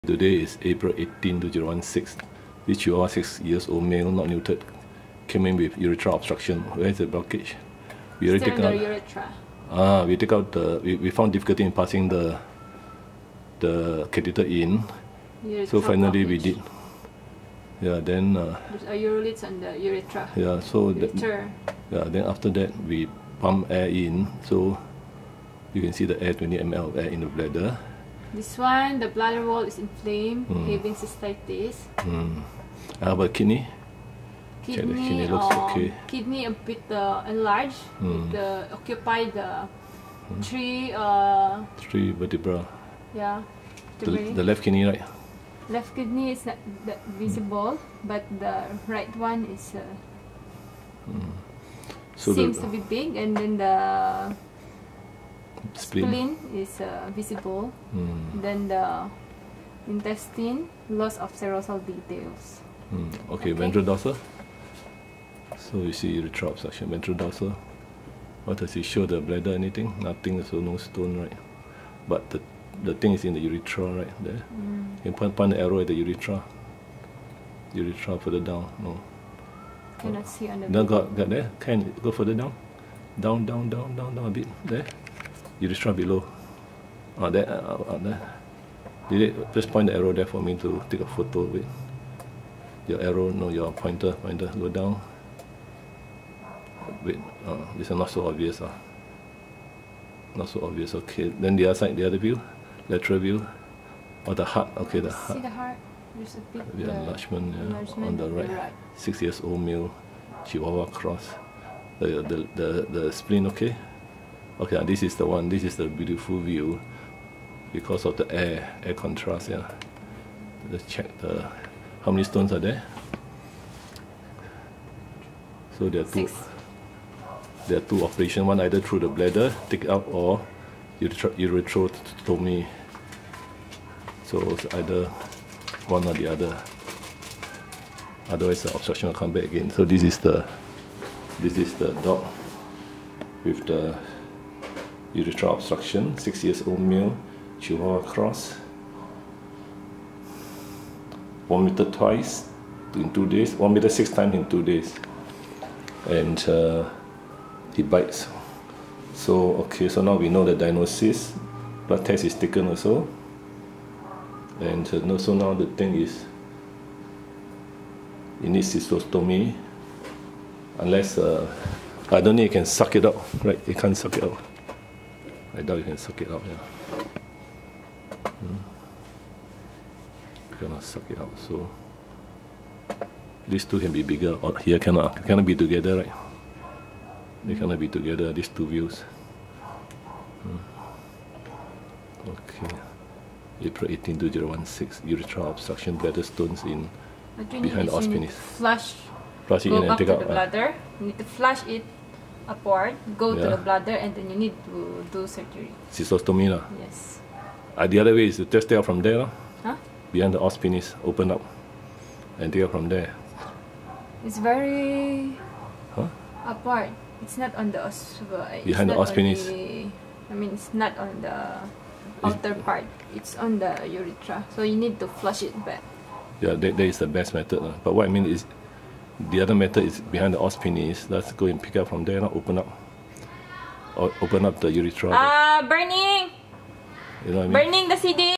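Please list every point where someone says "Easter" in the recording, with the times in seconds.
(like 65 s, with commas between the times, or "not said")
not said.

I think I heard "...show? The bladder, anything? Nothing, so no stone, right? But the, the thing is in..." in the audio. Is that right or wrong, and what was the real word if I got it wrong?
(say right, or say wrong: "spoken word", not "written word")
right.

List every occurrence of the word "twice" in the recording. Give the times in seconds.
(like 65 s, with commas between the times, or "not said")
151 s.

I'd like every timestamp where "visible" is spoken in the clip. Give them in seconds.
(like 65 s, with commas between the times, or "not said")
47 s, 57 s.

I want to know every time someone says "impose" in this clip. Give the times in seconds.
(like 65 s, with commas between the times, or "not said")
not said.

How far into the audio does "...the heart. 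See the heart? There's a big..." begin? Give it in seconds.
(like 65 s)
104 s.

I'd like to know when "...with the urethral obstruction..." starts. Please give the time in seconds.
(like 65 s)
143 s.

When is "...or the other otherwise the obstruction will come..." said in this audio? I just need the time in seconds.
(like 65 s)
136 s.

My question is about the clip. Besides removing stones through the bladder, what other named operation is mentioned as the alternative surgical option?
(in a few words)
urethrotomy.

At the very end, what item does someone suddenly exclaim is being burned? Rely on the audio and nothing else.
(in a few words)
CD.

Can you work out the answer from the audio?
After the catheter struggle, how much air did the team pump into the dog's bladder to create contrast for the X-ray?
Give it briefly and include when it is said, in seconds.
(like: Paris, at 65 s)
20 ml, at 26 s.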